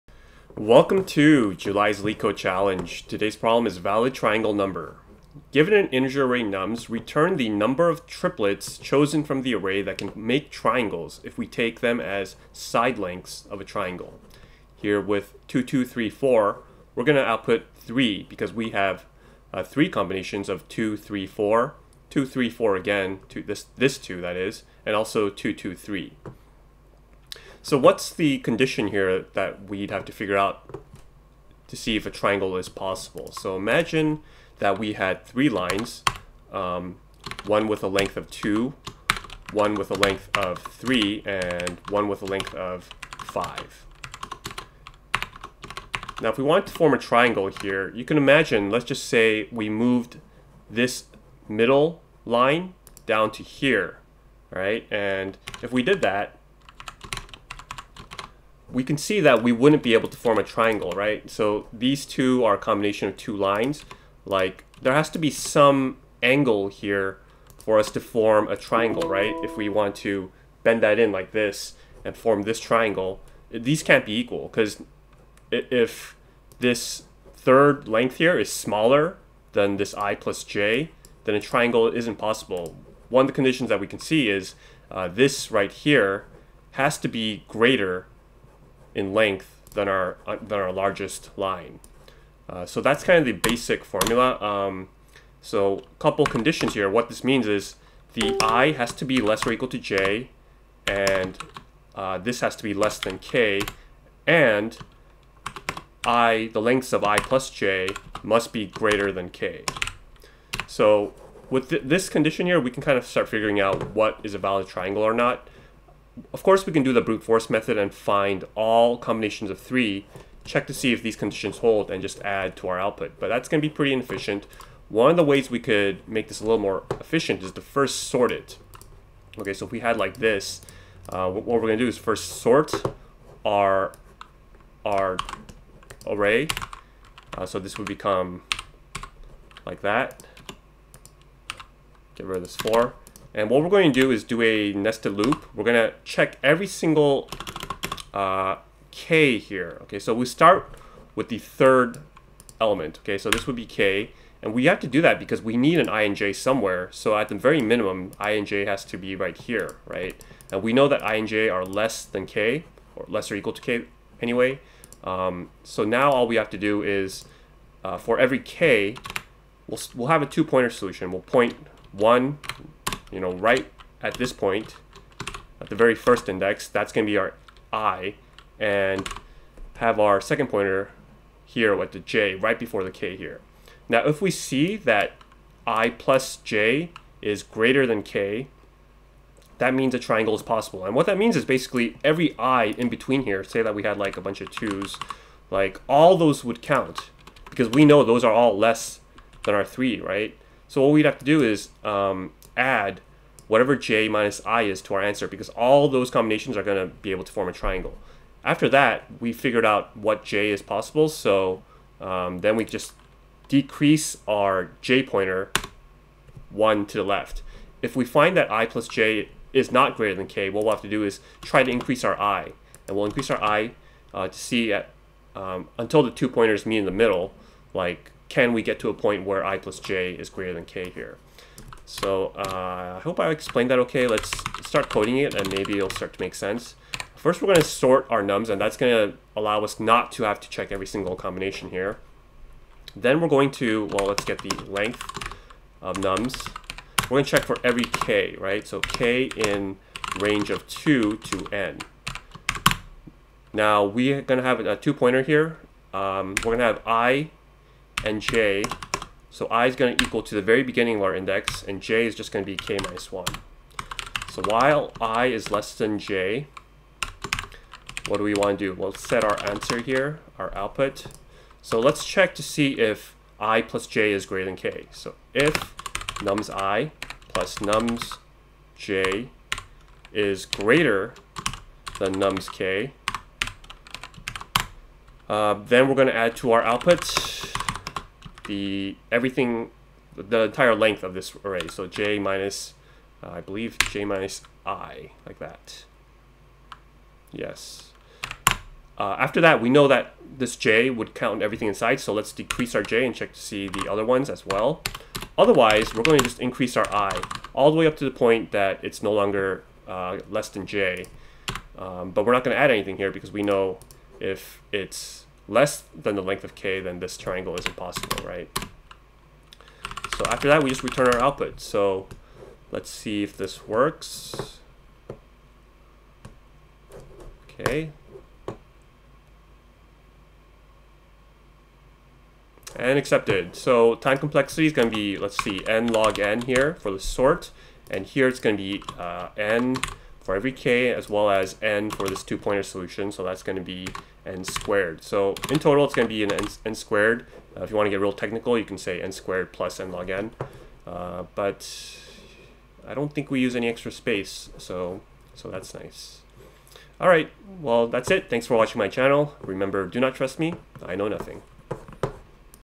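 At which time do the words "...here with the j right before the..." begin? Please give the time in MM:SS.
03:01.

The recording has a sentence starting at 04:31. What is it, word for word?
So let's check to see if i plus j is greater than k.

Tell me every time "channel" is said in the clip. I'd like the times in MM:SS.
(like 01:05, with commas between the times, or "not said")
05:58.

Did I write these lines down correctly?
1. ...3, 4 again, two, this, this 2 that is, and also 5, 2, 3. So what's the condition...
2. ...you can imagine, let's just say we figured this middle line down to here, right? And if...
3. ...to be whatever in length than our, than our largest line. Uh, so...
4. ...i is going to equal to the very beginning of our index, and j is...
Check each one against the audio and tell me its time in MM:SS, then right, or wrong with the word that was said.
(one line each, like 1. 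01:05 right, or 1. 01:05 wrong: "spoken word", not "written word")
1. 00:22 wrong: "2", not "5"
2. 00:47 wrong: "moved", not "figured"
3. 01:26 wrong: "greater", not "whatever"
4. 04:19 right.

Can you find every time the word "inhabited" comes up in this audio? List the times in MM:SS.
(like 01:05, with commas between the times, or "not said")
not said.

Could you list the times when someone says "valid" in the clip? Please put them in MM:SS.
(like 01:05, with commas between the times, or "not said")
00:03, 01:54.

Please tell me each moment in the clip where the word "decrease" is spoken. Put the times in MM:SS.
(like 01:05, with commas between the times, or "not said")
03:33, 05:02.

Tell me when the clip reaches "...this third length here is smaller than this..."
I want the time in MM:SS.
01:16.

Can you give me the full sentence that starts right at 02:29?
Okay, so we start with the third element.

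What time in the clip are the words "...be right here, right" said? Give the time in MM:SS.
02:38.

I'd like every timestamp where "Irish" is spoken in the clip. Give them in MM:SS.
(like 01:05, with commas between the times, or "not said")
not said.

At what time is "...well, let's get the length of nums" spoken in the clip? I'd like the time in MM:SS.
04:03.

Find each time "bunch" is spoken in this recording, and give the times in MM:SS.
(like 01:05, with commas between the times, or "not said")
03:14.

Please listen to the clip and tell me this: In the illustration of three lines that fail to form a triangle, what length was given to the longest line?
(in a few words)
5.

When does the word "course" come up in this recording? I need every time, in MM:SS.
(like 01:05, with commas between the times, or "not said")
01:56.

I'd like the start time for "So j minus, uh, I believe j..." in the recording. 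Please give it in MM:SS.
04:51.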